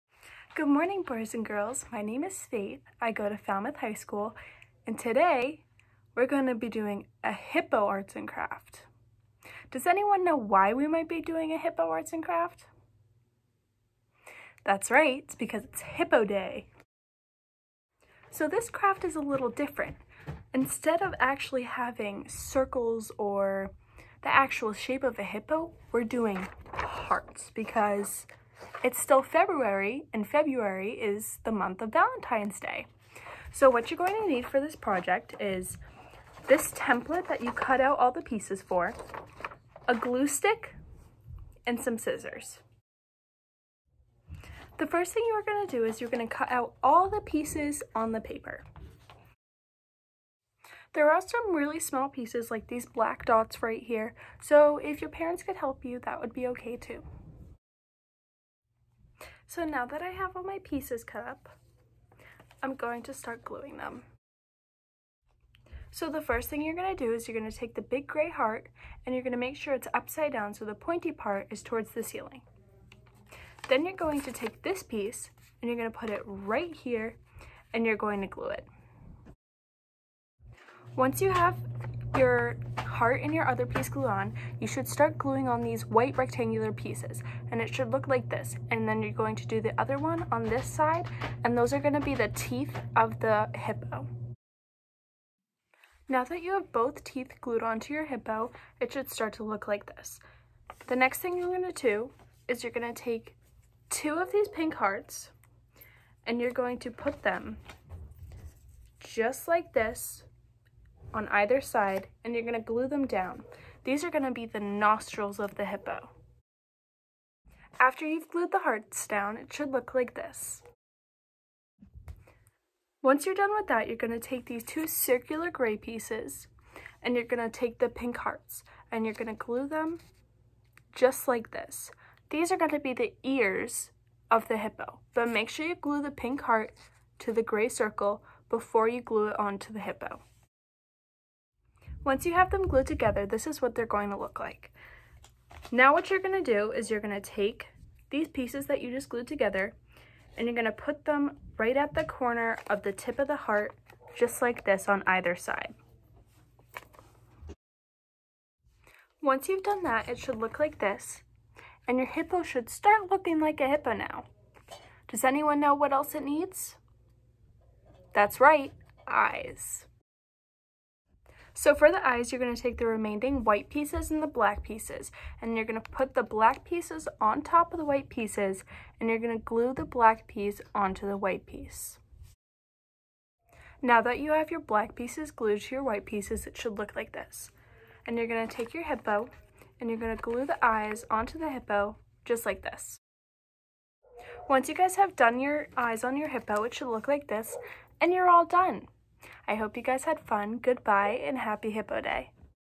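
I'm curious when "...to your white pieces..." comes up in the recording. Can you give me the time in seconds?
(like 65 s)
185 s.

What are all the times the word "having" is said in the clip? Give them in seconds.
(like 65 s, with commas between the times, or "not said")
21 s.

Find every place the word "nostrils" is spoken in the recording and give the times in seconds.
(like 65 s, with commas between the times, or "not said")
114 s.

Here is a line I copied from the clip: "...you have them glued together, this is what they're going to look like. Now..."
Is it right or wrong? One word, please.
right.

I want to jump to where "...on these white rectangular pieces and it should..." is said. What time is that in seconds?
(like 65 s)
85 s.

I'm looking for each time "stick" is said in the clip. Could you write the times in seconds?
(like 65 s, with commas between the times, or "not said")
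40 s.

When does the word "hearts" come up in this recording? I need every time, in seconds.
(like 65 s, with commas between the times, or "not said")
26 s, 68 s, 104 s, 118 s, 128 s, 136 s, 153 s.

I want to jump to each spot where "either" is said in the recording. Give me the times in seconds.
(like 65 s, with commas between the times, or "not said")
111 s, 155 s.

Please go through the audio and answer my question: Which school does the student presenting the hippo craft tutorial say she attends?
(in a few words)
Falmouth High School.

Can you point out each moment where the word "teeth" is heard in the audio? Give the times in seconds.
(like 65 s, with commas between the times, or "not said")
92 s, 97 s.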